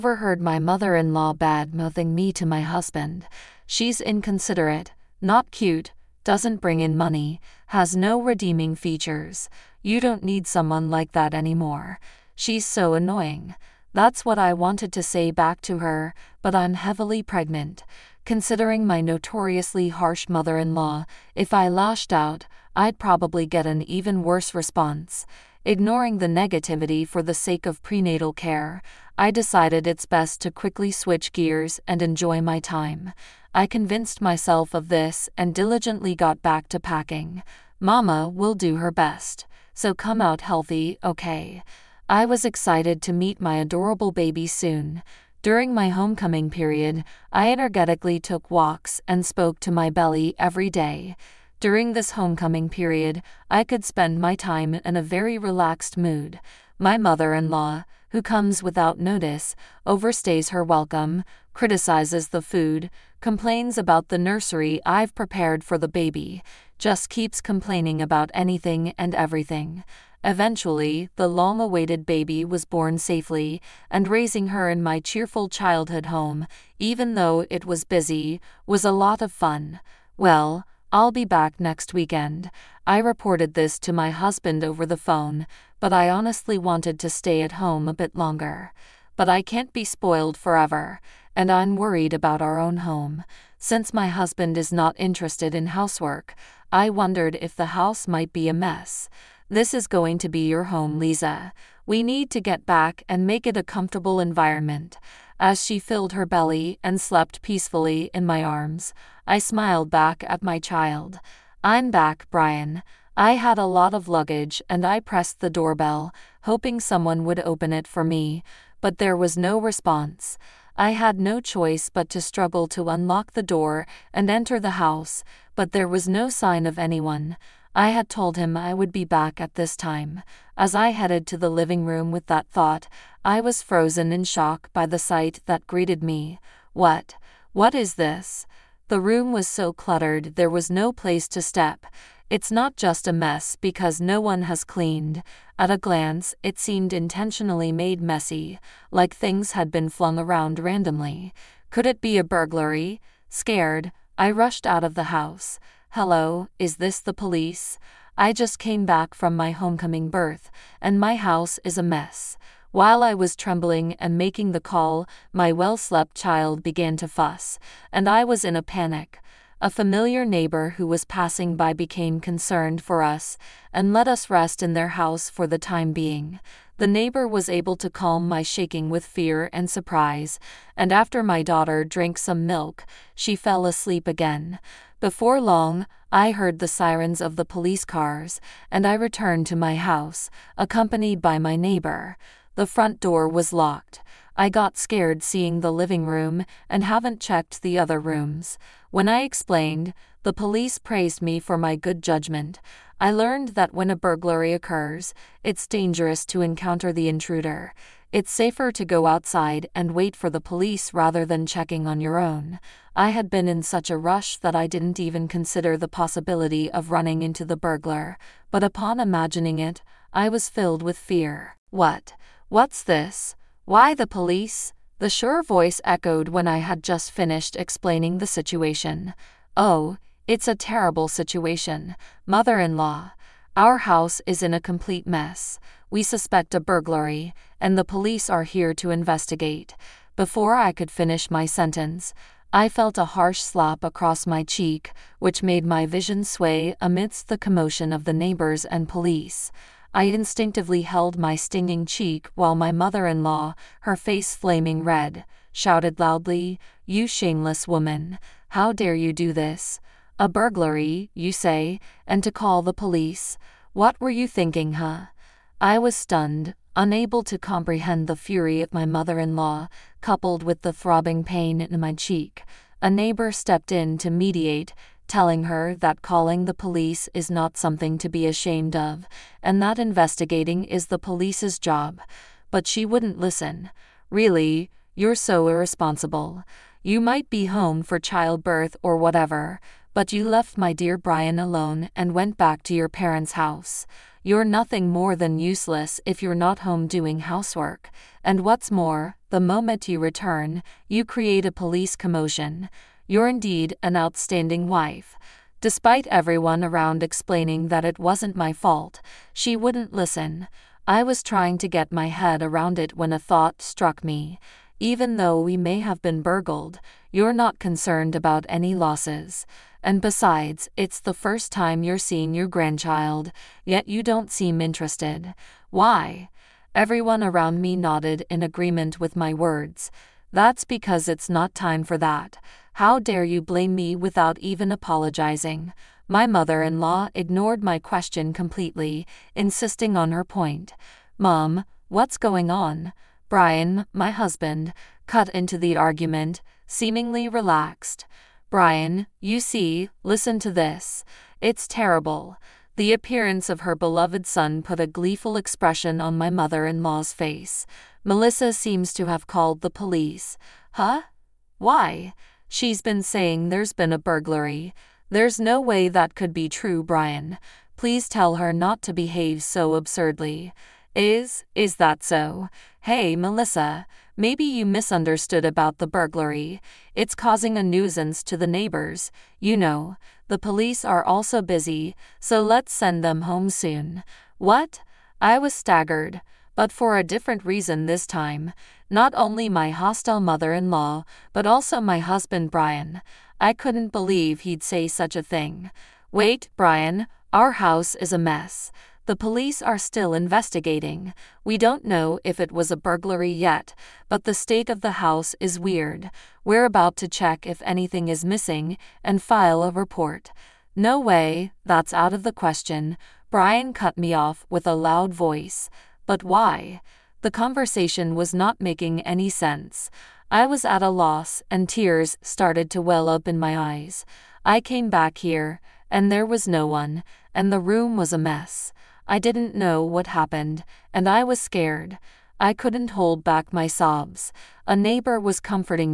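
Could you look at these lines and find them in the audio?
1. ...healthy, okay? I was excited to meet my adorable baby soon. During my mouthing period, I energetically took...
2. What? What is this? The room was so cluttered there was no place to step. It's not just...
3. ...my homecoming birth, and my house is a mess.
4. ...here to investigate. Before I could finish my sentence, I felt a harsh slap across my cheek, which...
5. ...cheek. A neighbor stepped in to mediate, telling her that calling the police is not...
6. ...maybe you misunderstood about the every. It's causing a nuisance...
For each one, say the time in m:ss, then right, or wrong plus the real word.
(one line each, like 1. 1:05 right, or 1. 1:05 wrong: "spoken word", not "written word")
1. 0:40 wrong: "homecoming", not "mouthing"
2. 2:16 right
3. 2:39 right
4. 3:58 right
5. 4:31 right
6. 6:14 wrong: "burglary", not "every".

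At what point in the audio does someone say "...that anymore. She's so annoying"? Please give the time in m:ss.
0:11.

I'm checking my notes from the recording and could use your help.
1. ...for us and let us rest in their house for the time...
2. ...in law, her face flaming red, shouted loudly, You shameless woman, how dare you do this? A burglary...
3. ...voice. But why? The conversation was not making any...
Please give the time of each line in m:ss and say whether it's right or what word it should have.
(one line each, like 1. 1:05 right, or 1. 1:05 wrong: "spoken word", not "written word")
1. 2:52 right
2. 4:13 right
3. 6:55 right.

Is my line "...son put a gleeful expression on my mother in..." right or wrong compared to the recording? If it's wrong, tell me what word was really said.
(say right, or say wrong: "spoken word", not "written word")
right.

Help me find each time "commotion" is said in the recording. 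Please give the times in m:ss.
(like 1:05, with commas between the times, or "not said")
4:07, 5:01.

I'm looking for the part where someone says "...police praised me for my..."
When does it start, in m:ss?
3:20.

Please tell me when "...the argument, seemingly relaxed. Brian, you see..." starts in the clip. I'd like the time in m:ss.
5:45.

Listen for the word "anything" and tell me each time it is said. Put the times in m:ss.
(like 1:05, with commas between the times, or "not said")
1:08, 6:47.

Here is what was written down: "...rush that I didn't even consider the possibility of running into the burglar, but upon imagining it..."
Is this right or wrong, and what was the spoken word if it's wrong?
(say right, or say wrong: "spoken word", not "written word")
right.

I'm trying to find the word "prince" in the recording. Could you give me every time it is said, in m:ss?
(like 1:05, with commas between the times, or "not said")
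not said.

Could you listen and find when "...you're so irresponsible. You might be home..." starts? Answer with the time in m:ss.
4:44.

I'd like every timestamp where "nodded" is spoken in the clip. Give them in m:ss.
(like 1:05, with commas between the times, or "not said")
5:27.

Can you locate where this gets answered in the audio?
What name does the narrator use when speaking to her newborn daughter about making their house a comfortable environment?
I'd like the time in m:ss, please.
1:40.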